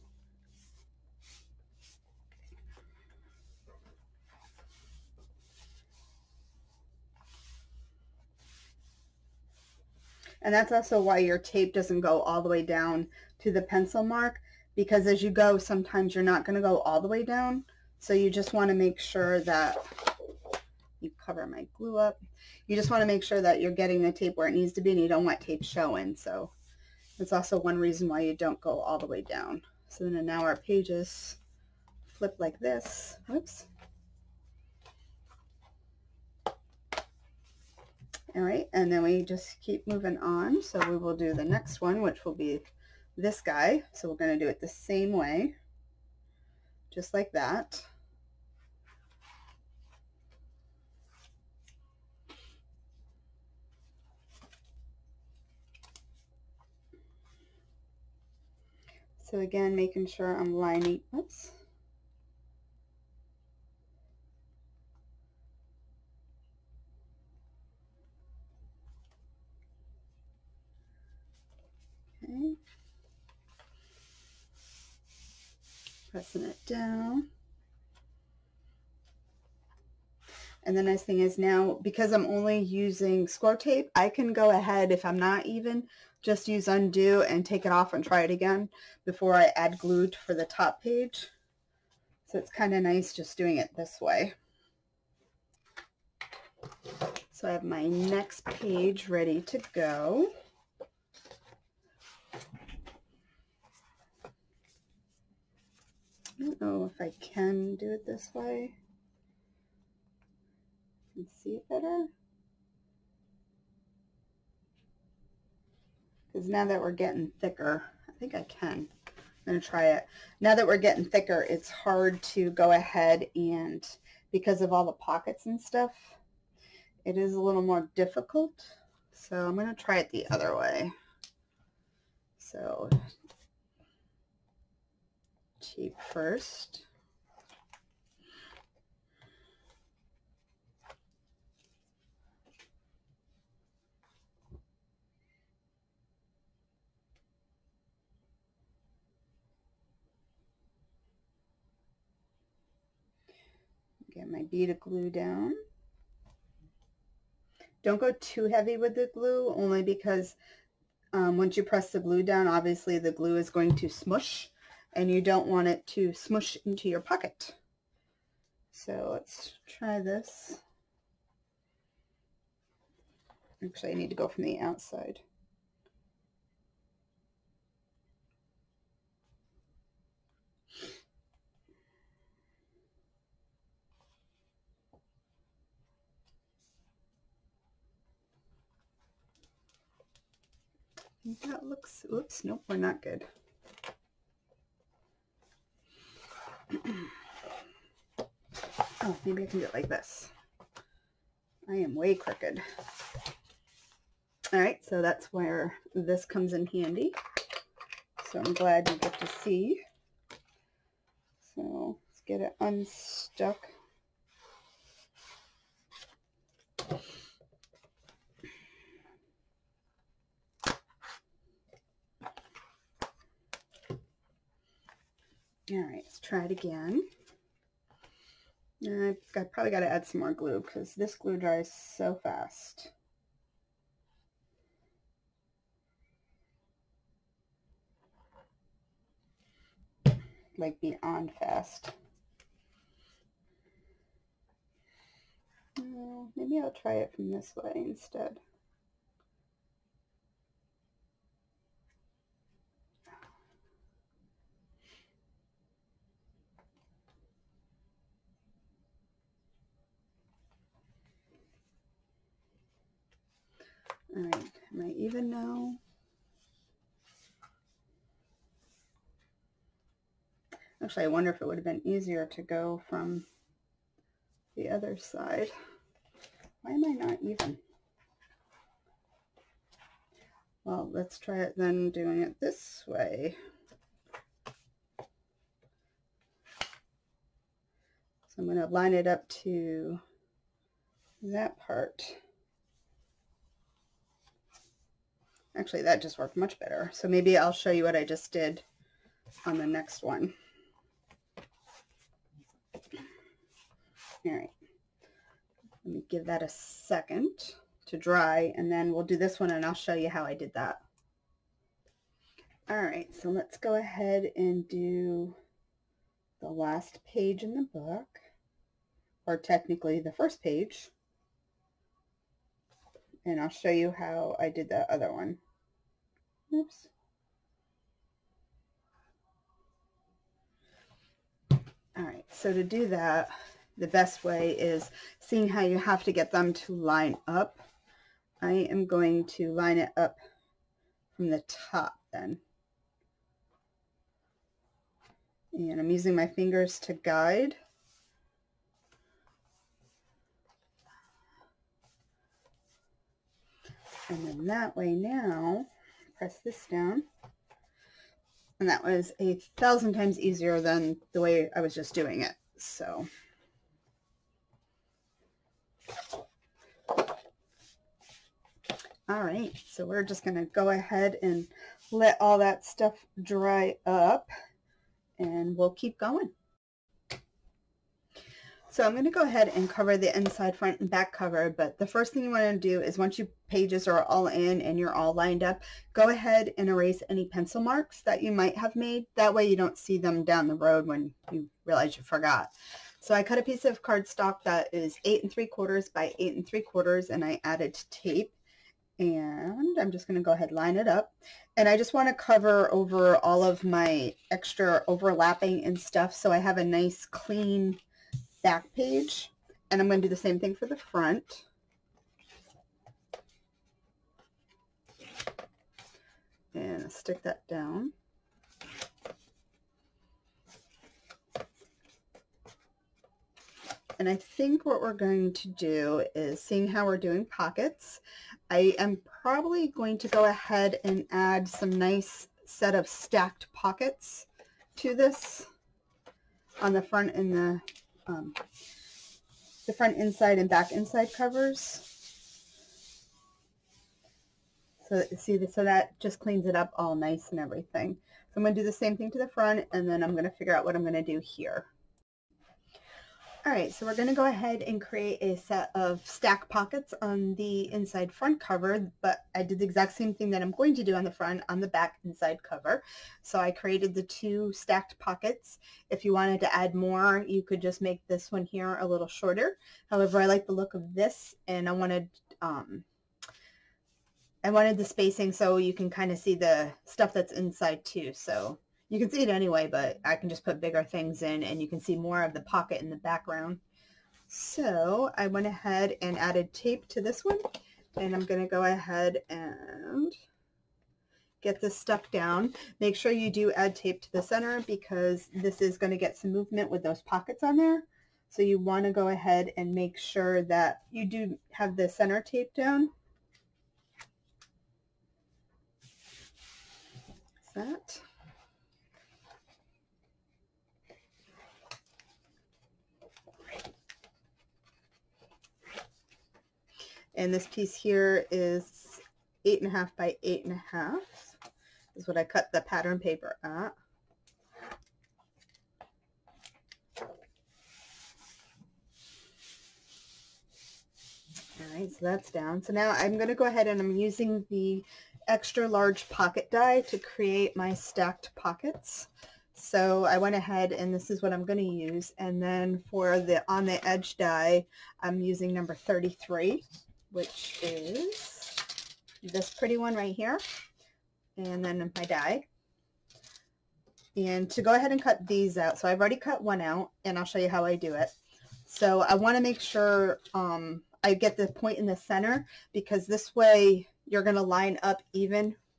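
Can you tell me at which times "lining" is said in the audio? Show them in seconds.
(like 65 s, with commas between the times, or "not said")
60 s.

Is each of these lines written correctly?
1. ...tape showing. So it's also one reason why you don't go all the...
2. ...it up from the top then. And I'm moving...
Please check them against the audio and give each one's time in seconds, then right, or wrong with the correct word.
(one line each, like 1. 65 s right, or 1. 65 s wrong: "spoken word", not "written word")
1. 25 s right
2. 339 s wrong: "using", not "moving".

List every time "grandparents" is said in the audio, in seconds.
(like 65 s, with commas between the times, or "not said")
not said.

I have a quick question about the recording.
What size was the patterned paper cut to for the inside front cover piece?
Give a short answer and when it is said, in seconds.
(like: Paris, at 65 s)
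8 1/2 by 8 1/2, at 519 s.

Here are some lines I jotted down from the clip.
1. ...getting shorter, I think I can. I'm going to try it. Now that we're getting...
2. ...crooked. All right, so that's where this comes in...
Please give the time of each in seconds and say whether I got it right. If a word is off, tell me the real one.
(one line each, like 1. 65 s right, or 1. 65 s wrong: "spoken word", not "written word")
1. 116 s wrong: "thicker", not "shorter"
2. 202 s right.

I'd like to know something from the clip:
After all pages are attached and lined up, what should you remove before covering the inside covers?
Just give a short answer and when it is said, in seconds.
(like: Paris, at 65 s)
pencil marks, at 387 s.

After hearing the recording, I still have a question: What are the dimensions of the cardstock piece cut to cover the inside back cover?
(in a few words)
8 3/4 by 8 3/4.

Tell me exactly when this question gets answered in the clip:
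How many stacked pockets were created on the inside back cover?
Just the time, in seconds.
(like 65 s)
464 s.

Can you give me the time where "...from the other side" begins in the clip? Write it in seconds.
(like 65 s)
272 s.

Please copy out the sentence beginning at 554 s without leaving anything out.
And to go ahead and cut these out, so I've already cut one out, and I'll show you how I do it.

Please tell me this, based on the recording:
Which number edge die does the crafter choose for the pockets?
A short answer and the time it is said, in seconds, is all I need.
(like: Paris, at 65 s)
33, at 545 s.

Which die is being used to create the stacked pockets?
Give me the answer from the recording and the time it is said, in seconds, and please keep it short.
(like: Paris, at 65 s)
extra large pocket die, at 535 s.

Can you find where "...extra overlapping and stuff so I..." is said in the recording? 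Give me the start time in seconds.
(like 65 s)
404 s.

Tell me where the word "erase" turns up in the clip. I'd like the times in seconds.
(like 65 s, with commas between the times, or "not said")
386 s.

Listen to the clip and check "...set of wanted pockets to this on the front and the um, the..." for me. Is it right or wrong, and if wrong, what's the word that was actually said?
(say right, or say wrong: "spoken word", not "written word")
wrong: "stacked", not "wanted".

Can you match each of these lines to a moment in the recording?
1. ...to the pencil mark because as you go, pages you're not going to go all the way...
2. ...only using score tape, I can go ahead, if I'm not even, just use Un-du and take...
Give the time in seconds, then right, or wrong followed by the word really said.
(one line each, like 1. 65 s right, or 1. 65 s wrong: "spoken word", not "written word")
1. 13 s wrong: "sometimes", not "pages"
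2. 82 s right.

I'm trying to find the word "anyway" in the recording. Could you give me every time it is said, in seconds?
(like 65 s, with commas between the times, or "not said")
479 s.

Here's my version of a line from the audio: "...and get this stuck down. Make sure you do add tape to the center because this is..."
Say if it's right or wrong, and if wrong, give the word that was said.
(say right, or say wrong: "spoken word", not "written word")
right.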